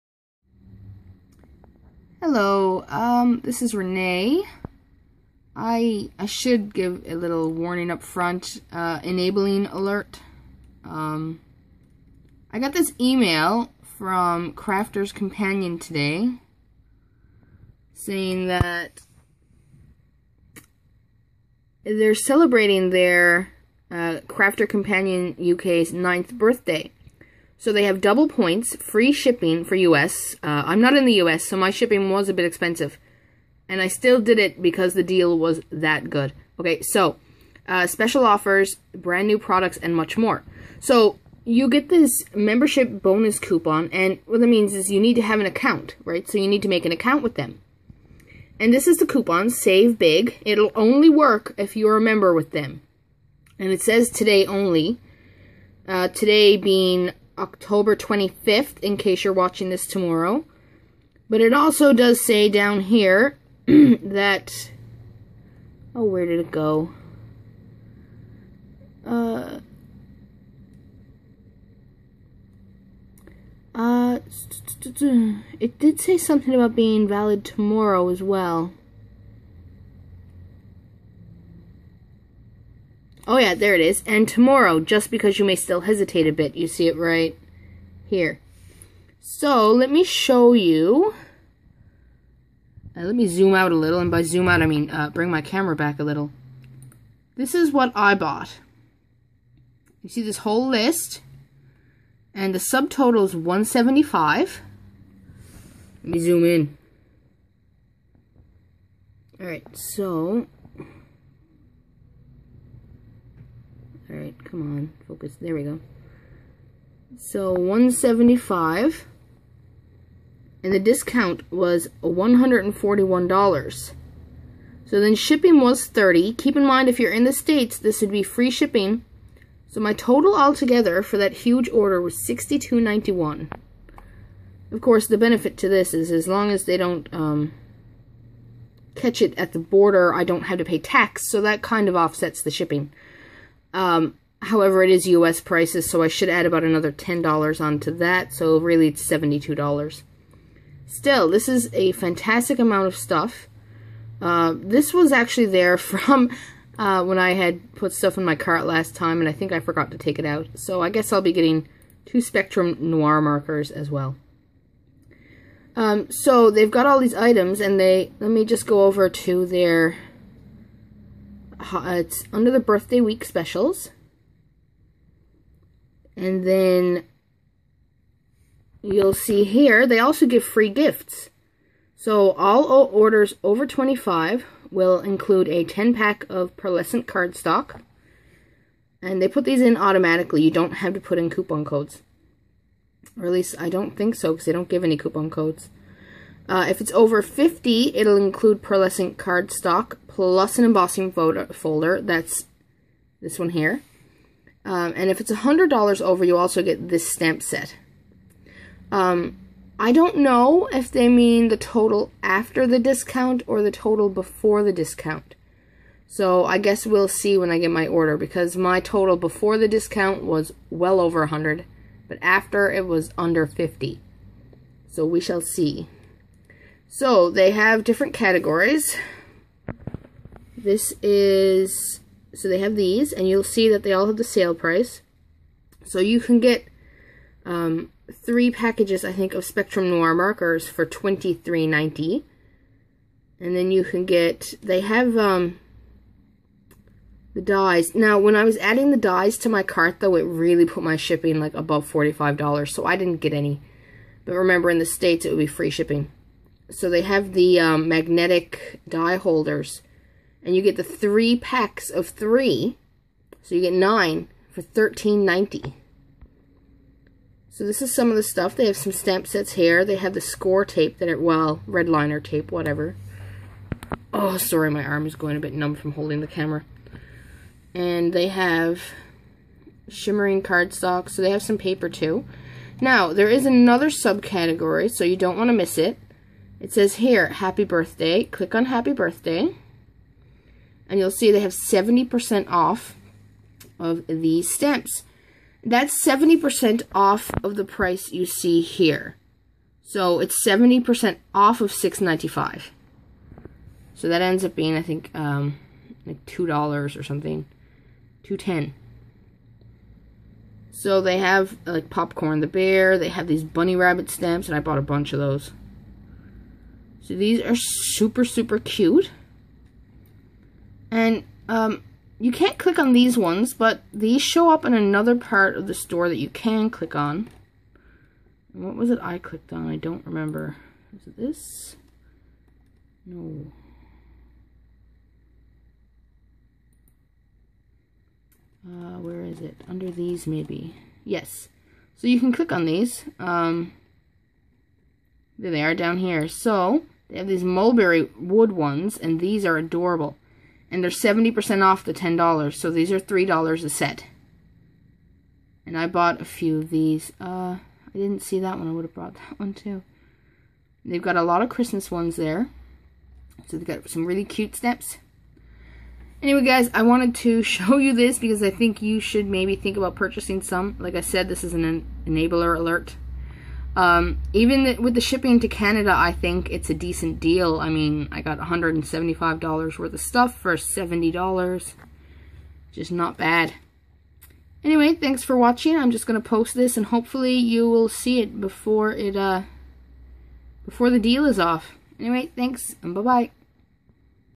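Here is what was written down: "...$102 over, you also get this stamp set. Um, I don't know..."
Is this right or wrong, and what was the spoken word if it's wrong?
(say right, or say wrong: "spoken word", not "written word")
wrong: "100", not "102".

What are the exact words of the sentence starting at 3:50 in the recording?
This is so they have these, and you'll see that they all have the sale price.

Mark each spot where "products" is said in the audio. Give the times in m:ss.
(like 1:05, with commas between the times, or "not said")
0:39.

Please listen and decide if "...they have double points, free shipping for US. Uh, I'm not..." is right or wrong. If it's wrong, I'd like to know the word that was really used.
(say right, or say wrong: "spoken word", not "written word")
right.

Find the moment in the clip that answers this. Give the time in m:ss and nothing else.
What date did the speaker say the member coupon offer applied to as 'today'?
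0:57.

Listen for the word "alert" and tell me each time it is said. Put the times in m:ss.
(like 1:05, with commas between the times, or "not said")
0:09, 6:12.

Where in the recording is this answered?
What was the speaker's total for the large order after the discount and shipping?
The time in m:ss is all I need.
2:12.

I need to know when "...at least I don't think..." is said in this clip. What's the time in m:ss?
3:13.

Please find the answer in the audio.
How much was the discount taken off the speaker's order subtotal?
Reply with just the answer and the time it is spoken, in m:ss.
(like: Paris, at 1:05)
$141, at 2:02.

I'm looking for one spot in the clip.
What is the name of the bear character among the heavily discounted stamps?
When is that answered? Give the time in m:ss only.
5:11.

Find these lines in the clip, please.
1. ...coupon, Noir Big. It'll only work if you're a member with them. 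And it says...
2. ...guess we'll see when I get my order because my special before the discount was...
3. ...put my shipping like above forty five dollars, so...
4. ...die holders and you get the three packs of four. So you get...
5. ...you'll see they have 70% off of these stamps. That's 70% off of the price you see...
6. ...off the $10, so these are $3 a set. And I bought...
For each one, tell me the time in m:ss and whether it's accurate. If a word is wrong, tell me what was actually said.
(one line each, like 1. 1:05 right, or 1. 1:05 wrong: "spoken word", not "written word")
1. 0:49 wrong: "Save", not "Noir"
2. 3:36 wrong: "total", not "special"
3. 4:10 right
4. 4:18 wrong: "three", not "four"
5. 4:50 right
6. 5:51 right.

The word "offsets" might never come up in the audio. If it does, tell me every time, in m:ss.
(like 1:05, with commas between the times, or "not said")
2:21.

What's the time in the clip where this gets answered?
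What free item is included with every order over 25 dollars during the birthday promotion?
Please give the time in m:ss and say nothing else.
3:05.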